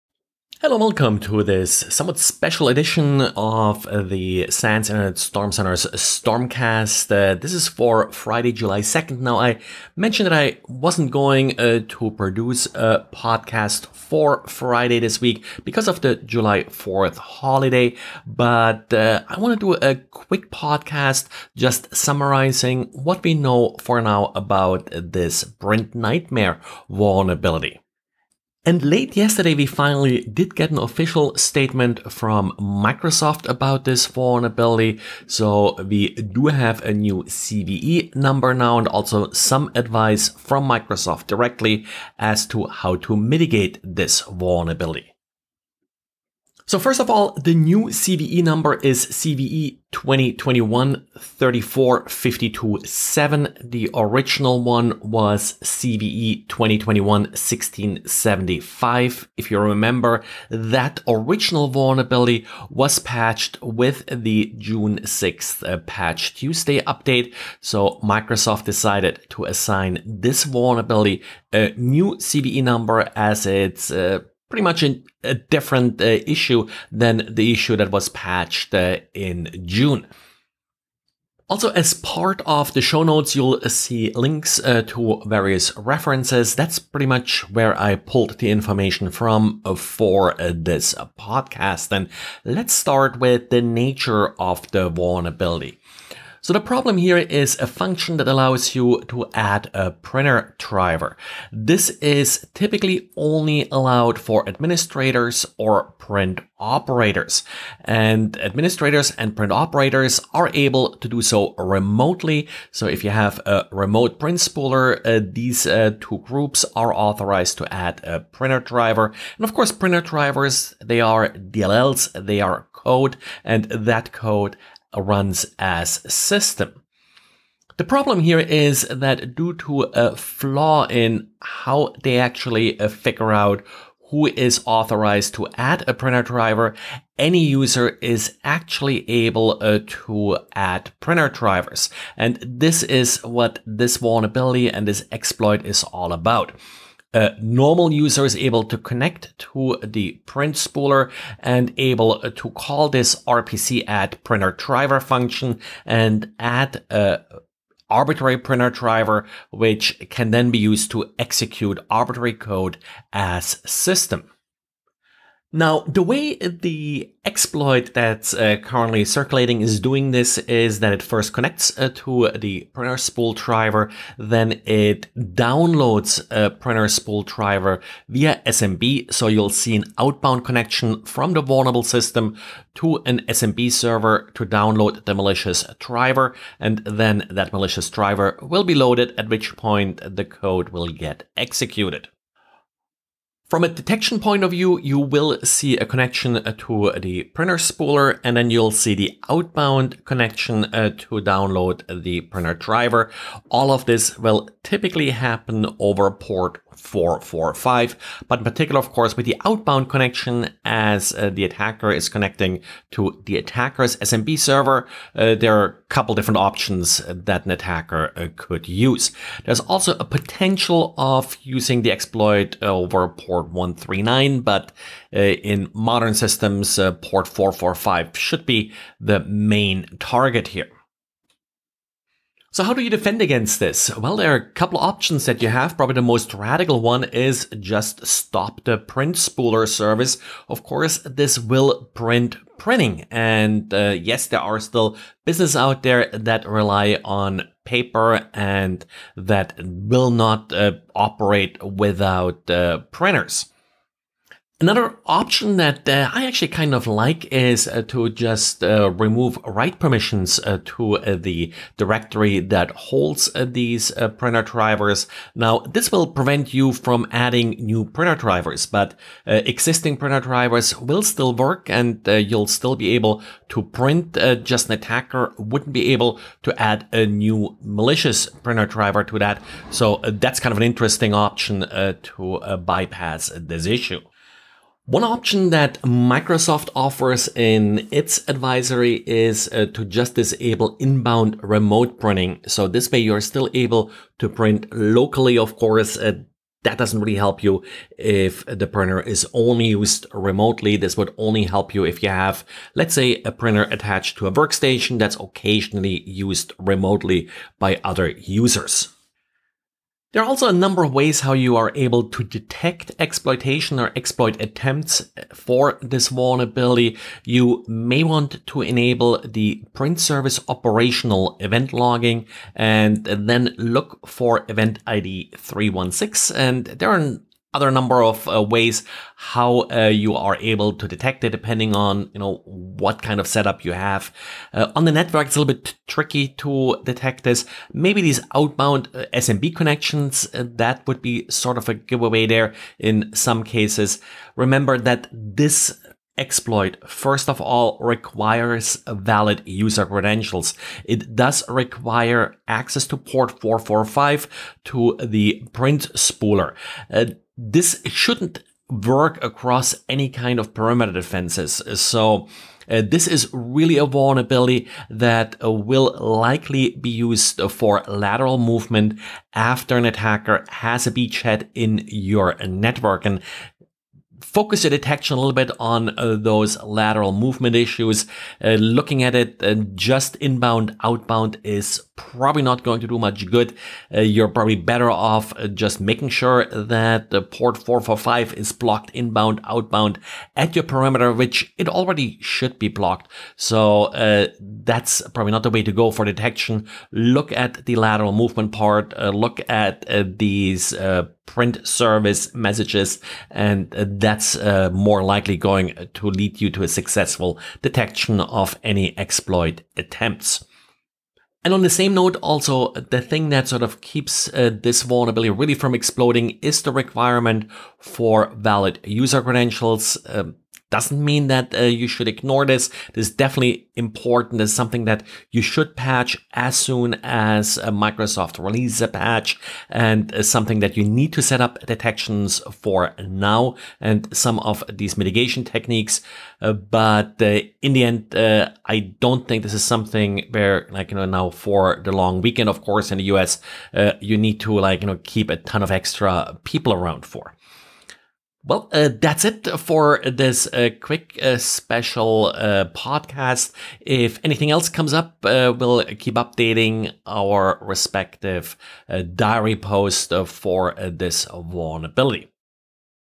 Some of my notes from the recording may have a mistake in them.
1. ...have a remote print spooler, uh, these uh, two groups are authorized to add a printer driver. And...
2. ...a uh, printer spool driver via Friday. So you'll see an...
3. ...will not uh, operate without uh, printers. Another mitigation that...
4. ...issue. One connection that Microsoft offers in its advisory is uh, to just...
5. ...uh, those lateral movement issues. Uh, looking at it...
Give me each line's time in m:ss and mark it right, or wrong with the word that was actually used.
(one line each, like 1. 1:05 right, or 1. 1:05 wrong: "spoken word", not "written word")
1. 1:53 right
2. 2:56 wrong: "SMB", not "Friday"
3. 4:09 wrong: "option", not "mitigation"
4. 4:43 wrong: "option", not "connection"
5. 6:15 right.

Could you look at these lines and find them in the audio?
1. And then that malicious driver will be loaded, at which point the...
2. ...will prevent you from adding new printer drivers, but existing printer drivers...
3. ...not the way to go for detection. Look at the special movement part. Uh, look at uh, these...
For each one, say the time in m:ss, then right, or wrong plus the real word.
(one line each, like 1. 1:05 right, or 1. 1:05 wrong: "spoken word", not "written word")
1. 3:06 right
2. 4:25 right
3. 6:35 wrong: "lateral", not "special".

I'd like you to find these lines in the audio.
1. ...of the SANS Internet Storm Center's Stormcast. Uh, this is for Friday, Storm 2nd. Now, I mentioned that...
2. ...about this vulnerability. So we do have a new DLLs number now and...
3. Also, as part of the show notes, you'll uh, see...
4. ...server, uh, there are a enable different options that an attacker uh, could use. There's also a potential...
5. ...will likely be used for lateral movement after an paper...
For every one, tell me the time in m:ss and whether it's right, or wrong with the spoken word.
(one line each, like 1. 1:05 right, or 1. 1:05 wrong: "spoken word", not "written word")
1. 0:03 wrong: "July", not "Storm"
2. 0:33 wrong: "CVE", not "DLLs"
3. 1:21 right
4. 3:34 wrong: "couple", not "enable"
5. 6:05 wrong: "attacker", not "paper".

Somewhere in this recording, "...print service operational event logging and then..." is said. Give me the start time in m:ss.
5:19.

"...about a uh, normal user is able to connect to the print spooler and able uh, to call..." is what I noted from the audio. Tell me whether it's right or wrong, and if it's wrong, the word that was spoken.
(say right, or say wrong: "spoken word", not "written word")
right.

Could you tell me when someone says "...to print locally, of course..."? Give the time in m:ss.
4:54.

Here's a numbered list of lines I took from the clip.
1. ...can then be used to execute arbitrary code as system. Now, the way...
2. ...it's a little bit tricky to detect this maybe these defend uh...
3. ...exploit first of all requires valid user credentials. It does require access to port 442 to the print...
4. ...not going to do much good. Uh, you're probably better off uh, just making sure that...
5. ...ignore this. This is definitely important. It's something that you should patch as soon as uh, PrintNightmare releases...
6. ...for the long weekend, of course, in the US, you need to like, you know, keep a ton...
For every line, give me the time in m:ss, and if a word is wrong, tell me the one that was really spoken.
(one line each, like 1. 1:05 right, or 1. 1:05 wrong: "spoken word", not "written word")
1. 2:40 right
2. 5:35 wrong: "outbound", not "defend"
3. 5:46 wrong: "445", not "442"
4. 6:22 right
5. 7:02 wrong: "Microsoft", not "PrintNightmare"
6. 7:21 right.